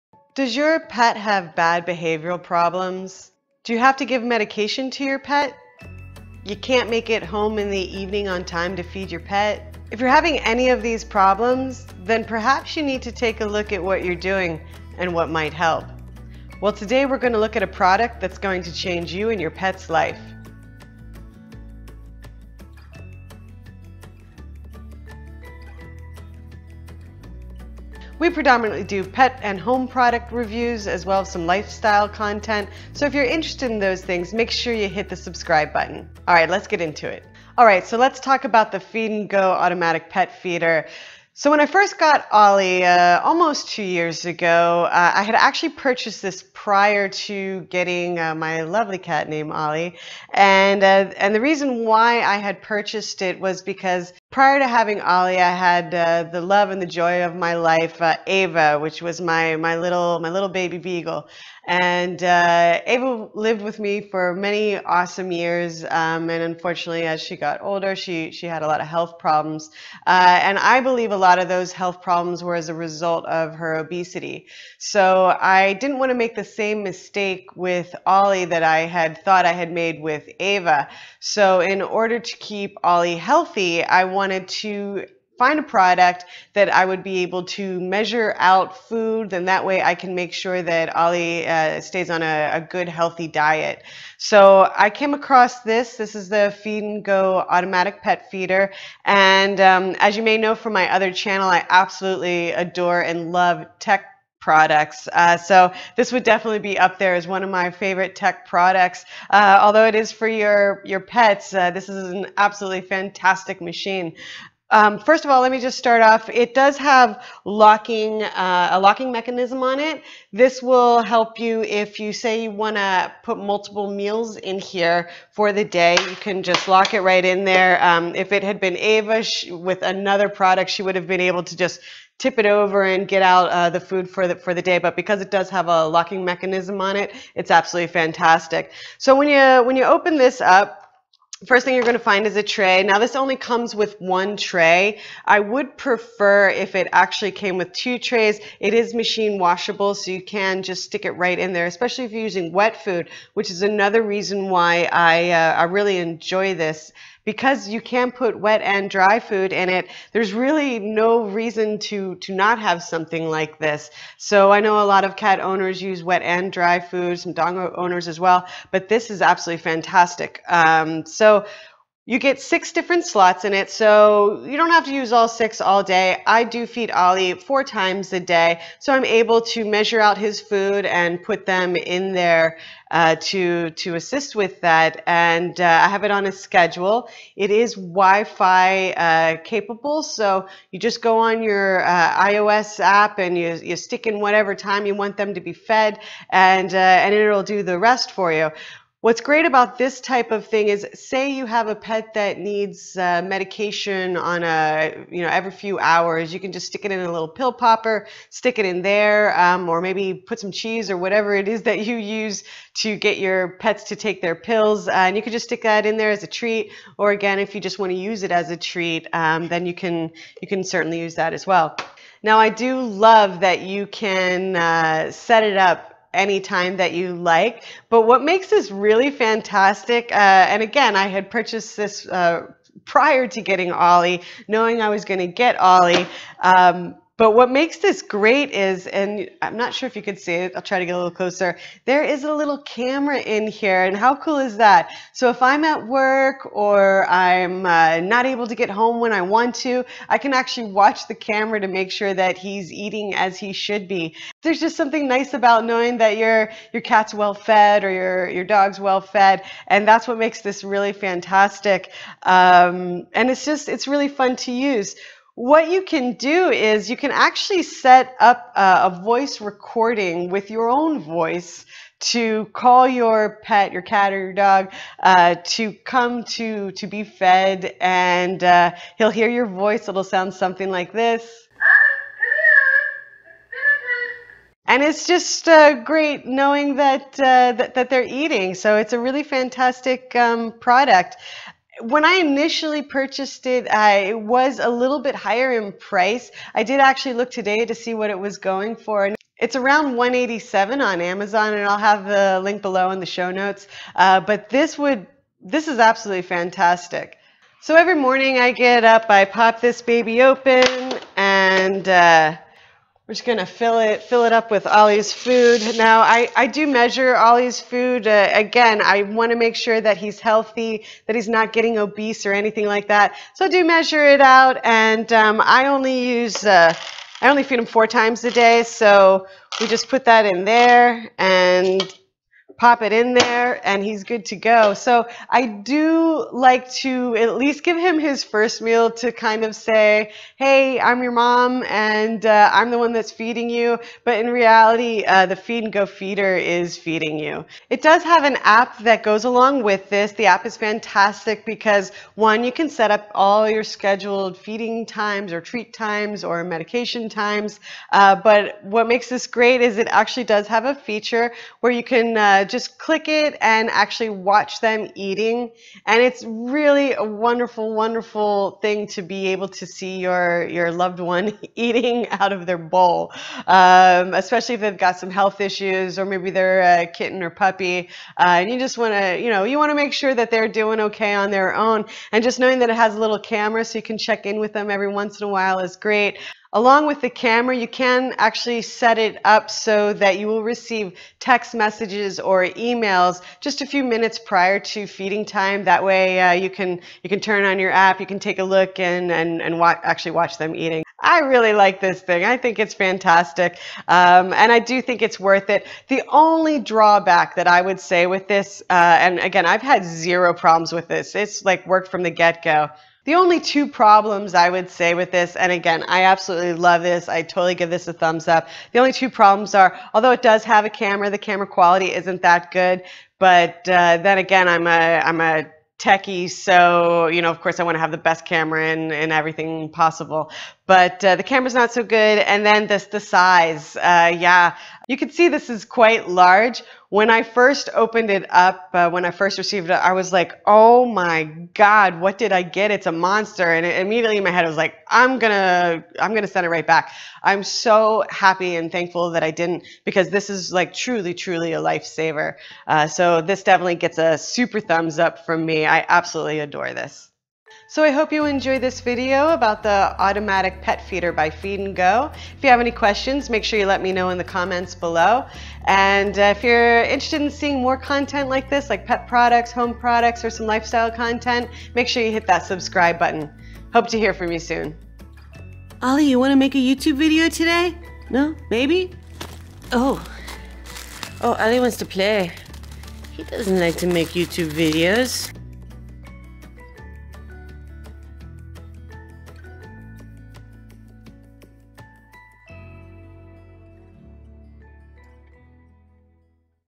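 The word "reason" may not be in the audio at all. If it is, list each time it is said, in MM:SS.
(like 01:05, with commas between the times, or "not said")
00:51, 02:34, 02:41.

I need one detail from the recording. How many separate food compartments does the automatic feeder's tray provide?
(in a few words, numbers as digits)
6.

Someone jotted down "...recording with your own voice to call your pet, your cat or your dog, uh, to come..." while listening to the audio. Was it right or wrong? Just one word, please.
right.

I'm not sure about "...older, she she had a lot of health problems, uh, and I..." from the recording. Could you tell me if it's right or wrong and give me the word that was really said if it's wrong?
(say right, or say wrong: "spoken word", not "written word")
right.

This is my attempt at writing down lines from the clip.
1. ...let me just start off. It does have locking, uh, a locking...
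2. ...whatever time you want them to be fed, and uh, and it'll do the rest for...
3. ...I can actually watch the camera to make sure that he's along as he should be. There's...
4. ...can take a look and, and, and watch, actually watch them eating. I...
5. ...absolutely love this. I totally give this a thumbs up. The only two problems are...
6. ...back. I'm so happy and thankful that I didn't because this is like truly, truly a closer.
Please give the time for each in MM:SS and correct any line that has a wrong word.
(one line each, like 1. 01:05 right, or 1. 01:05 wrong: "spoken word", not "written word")
1. 01:55 right
2. 03:14 right
3. 04:10 wrong: "eating", not "along"
4. 06:38 right
5. 06:56 right
6. 07:26 wrong: "lifesaver", not "closer".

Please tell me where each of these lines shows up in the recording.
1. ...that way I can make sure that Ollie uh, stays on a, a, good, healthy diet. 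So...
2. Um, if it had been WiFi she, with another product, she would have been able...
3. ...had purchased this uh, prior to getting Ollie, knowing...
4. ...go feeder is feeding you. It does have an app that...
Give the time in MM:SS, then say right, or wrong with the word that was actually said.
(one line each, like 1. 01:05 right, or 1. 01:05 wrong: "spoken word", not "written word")
1. 01:29 right
2. 02:07 wrong: "Ava", not "WiFi"
3. 03:51 right
4. 05:45 right.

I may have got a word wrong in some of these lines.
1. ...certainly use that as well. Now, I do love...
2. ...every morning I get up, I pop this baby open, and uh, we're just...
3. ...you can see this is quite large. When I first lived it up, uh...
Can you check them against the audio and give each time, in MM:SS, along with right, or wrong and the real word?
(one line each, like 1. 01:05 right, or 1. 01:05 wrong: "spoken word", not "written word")
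1. 03:40 right
2. 05:07 right
3. 07:14 wrong: "opened", not "lived".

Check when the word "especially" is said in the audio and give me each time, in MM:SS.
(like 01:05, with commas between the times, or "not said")
02:31, 06:14.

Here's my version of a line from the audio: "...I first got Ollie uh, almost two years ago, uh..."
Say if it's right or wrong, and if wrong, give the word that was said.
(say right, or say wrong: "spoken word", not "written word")
right.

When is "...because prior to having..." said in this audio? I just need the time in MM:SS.
00:53.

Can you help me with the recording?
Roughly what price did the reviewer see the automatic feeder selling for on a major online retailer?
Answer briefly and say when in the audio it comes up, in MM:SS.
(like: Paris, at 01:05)
187, at 04:59.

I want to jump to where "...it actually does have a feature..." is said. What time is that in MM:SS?
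05:59.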